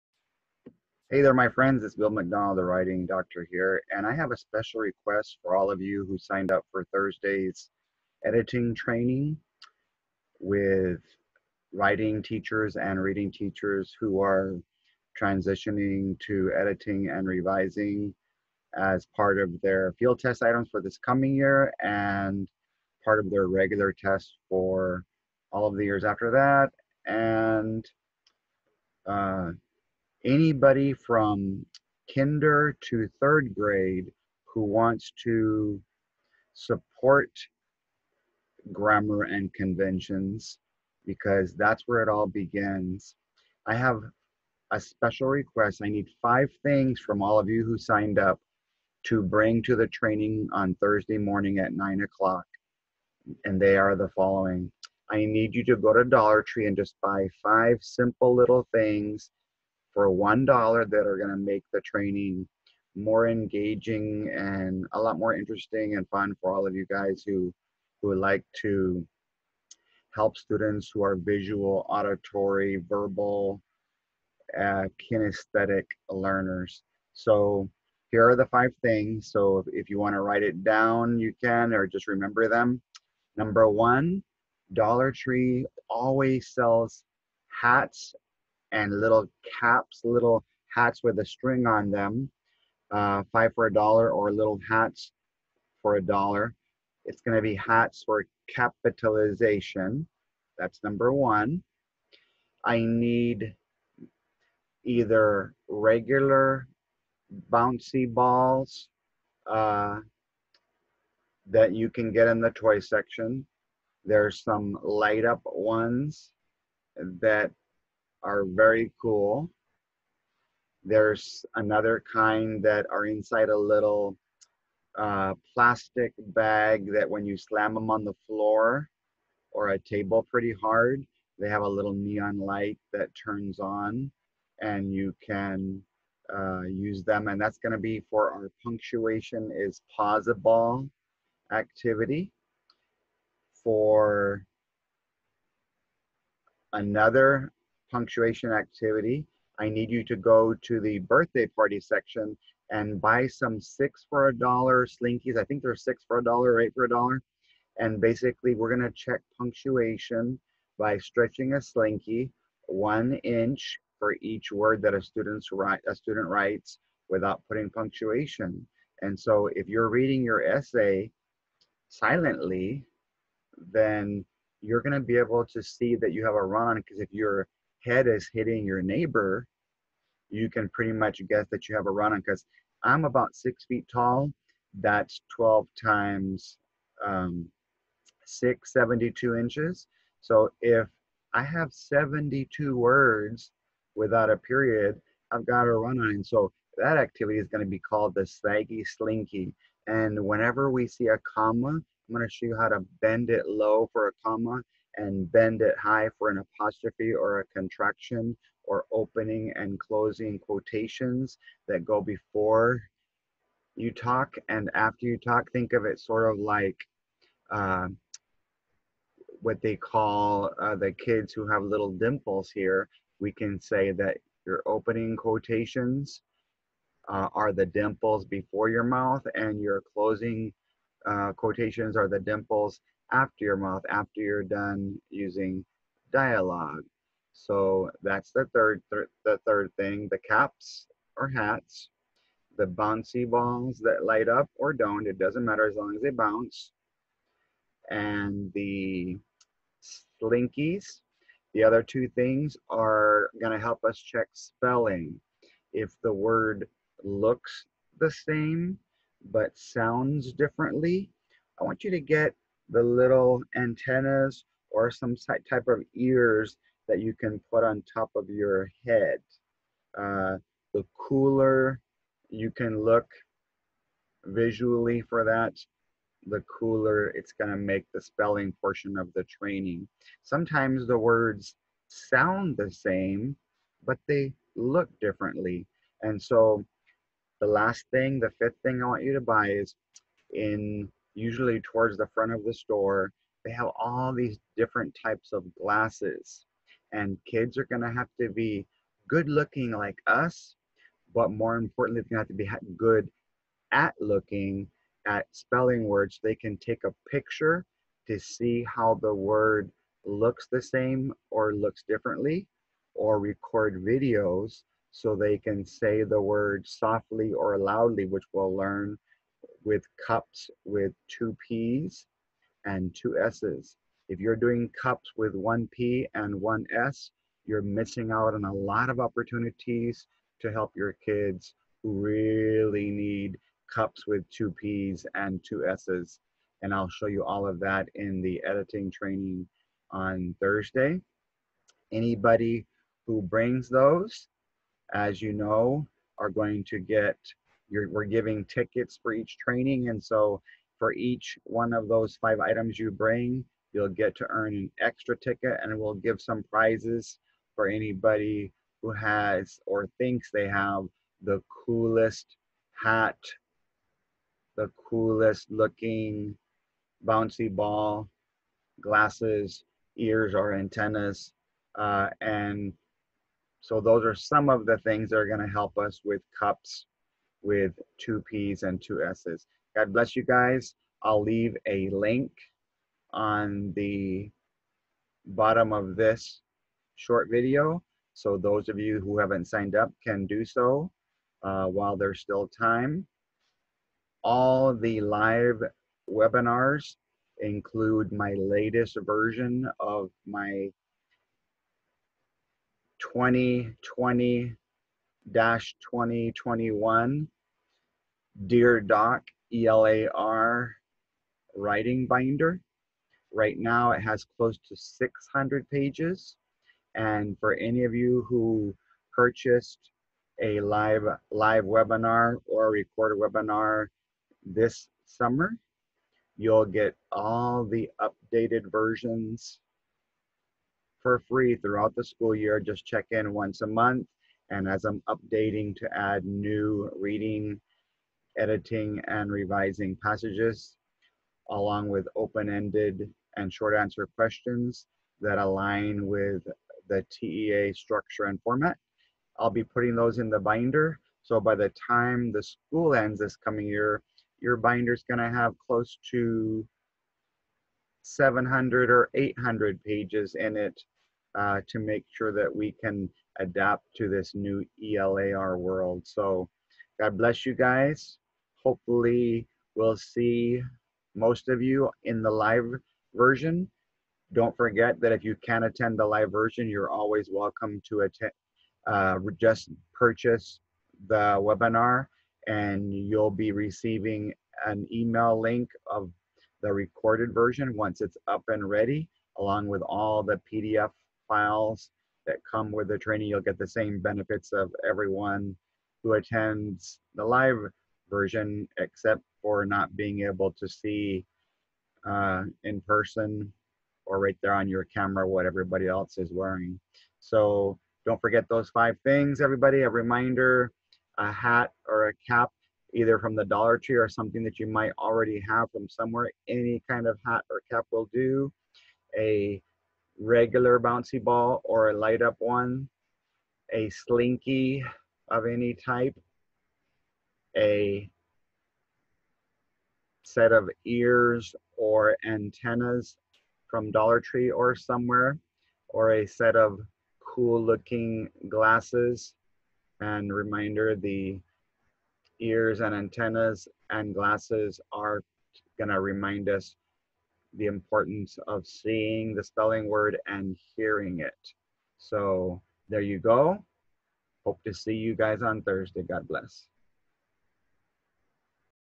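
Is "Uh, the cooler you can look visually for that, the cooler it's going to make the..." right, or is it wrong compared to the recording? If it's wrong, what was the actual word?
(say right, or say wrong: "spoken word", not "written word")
right.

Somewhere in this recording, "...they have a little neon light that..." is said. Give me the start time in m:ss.
2:11.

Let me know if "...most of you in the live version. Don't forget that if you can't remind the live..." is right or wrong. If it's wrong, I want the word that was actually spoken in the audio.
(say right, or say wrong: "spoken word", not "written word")
wrong: "attend", not "remind".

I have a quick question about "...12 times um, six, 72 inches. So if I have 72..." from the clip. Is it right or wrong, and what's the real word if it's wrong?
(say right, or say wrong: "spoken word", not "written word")
right.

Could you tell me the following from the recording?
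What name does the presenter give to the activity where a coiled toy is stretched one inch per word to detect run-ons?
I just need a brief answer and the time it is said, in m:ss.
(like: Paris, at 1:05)
the slaggy slinky, at 3:18.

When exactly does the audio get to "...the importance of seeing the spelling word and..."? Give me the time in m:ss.
9:07.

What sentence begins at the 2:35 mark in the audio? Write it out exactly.
I think they're six for a dollar or eight for a dollar.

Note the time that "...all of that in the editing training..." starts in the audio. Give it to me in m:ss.
5:37.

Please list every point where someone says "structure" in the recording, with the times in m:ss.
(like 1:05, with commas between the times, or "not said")
7:27.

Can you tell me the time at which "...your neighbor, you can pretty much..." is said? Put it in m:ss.
2:58.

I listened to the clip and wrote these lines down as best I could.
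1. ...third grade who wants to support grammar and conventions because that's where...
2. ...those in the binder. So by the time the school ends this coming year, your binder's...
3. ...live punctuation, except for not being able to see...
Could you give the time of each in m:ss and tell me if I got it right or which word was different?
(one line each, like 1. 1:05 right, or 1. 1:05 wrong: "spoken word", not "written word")
1. 0:33 right
2. 7:29 right
3. 8:17 wrong: "version", not "punctuation".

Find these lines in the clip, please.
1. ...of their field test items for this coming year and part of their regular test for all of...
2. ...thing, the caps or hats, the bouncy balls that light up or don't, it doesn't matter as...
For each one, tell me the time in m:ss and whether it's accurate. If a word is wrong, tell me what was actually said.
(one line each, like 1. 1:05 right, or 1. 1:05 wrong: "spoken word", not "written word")
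1. 0:19 right
2. 3:59 right.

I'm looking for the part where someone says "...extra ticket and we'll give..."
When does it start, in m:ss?
5:54.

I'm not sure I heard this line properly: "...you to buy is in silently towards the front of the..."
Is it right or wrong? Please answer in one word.
wrong.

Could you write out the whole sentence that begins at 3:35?
Think of it sort of like uh, what they call uh, the kids who have little dimples here.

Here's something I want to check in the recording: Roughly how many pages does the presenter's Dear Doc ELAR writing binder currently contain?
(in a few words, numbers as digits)
600.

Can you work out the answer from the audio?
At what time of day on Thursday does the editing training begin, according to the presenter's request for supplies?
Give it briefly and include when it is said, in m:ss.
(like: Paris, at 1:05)
9 o'clock, at 0:51.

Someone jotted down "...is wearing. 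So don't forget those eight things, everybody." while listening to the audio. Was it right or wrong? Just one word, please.
wrong.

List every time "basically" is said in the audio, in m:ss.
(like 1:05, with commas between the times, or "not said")
2:37.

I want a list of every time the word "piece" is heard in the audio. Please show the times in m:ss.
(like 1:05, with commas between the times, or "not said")
not said.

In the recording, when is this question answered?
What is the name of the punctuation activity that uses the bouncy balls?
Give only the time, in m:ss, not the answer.
2:18.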